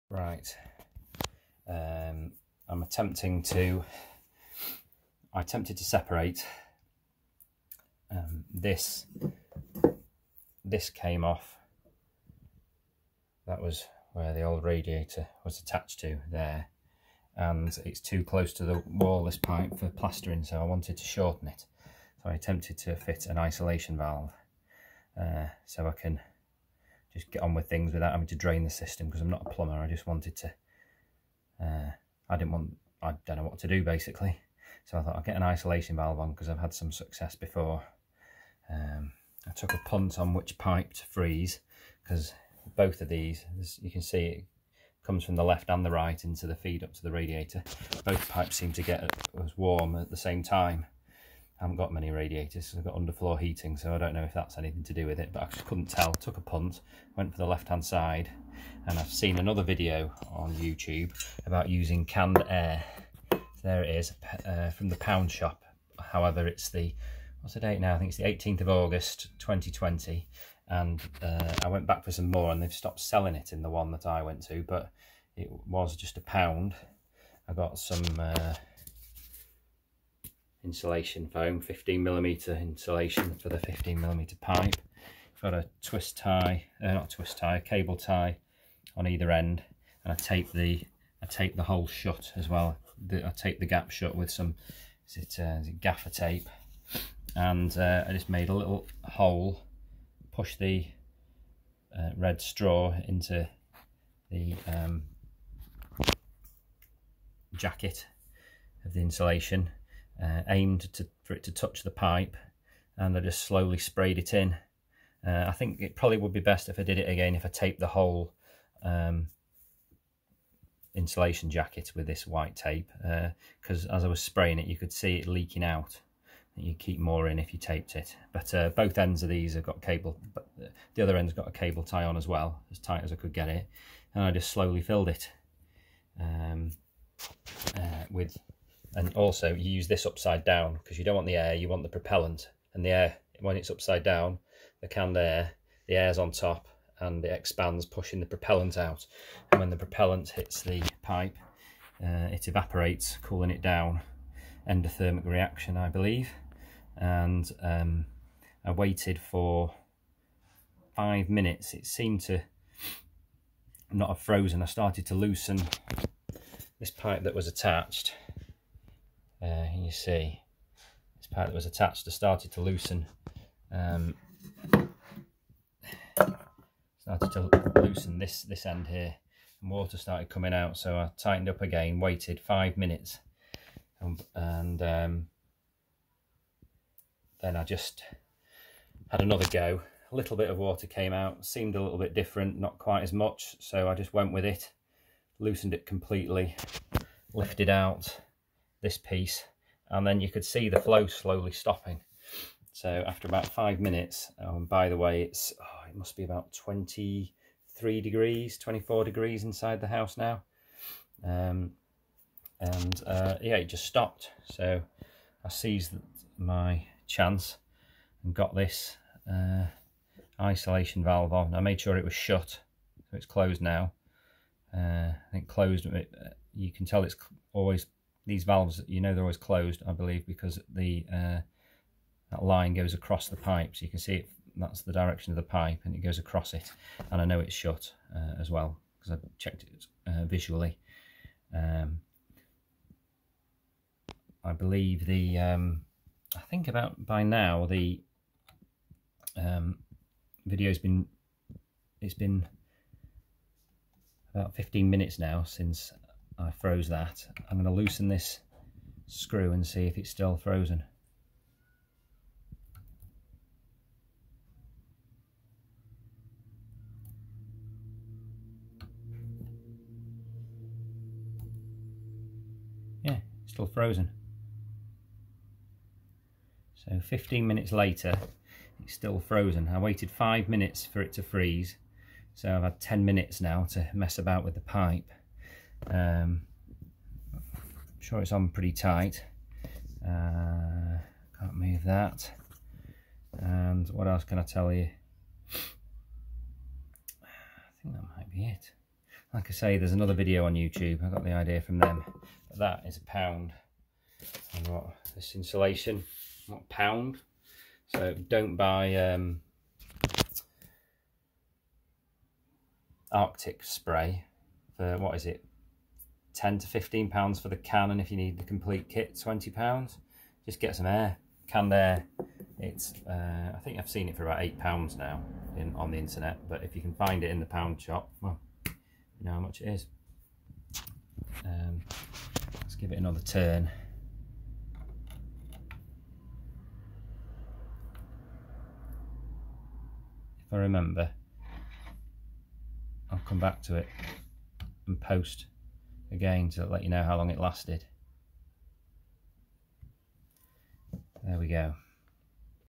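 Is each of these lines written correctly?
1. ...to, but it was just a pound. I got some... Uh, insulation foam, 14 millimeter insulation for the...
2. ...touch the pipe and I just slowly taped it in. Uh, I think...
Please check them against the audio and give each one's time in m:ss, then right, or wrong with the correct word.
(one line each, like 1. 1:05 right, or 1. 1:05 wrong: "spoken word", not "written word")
1. 1:14 wrong: "15", not "14"
2. 1:51 wrong: "sprayed", not "taped".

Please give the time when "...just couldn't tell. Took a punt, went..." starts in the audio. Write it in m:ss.
0:55.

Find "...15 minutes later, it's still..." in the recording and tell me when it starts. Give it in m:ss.
4:36.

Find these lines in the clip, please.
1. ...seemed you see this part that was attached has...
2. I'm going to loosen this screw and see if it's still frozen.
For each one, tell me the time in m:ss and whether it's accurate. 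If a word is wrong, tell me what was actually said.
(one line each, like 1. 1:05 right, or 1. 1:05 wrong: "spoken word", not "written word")
1. 2:47 wrong: "attached", not "seemed"
2. 4:17 right.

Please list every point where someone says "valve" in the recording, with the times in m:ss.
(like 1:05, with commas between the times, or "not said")
0:23, 0:35, 3:41, 3:48.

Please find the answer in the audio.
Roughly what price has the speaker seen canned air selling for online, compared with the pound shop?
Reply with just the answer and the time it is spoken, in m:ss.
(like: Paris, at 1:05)
8 pounds, at 5:24.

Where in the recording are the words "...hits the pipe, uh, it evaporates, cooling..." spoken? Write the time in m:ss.
2:30.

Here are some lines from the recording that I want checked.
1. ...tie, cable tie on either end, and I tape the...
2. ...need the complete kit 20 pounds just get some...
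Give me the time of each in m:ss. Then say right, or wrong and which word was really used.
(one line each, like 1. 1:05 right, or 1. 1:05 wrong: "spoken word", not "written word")
1. 1:27 right
2. 5:18 right.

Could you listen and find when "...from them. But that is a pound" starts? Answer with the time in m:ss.
5:01.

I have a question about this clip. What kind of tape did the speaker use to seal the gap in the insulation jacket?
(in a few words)
gaffer tape.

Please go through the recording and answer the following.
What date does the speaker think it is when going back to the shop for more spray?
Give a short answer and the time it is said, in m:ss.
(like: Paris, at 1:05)
18th of August 2020, at 1:08.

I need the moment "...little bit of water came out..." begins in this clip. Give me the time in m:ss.
3:10.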